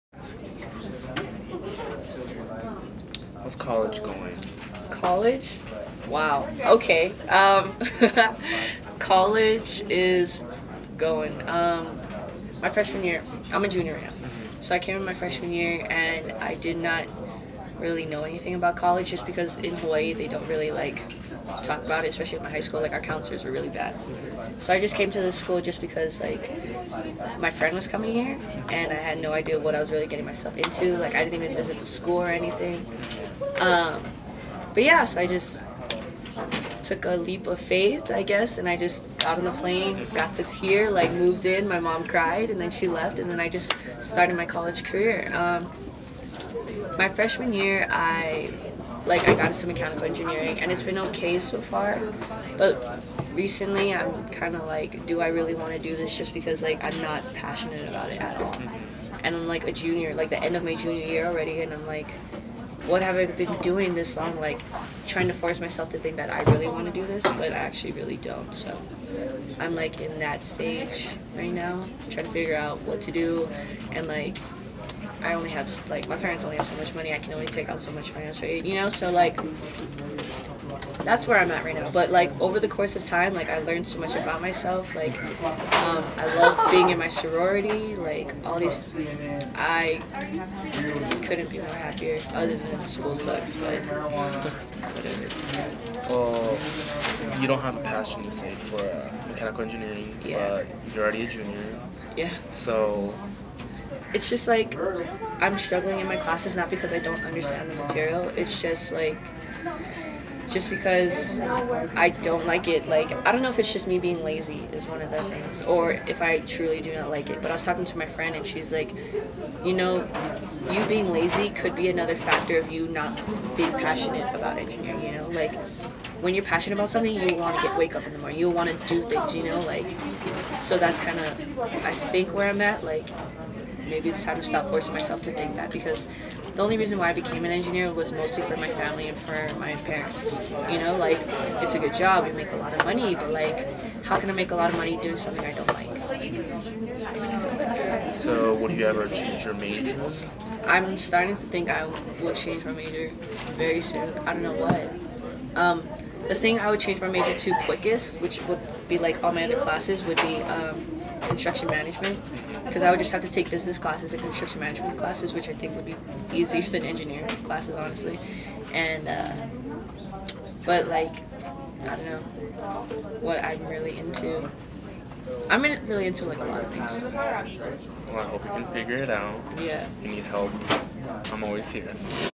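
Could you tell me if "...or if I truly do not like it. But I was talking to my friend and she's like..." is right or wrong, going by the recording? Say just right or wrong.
right.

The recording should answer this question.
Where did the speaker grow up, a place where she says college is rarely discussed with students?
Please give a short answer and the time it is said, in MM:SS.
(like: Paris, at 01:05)
Hawaii, at 00:19.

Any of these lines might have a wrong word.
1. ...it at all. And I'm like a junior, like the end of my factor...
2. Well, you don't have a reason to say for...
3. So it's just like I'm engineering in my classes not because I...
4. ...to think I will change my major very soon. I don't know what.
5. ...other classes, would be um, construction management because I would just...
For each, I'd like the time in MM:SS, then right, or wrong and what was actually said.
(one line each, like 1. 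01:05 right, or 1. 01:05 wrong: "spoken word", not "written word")
1. 00:58 wrong: "junior", not "factor"
2. 01:36 wrong: "passion", not "reason"
3. 01:42 wrong: "struggling", not "engineering"
4. 02:31 right
5. 02:39 right.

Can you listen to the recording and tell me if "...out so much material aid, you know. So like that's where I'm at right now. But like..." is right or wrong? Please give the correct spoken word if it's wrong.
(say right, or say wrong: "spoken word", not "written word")
wrong: "financial", not "material".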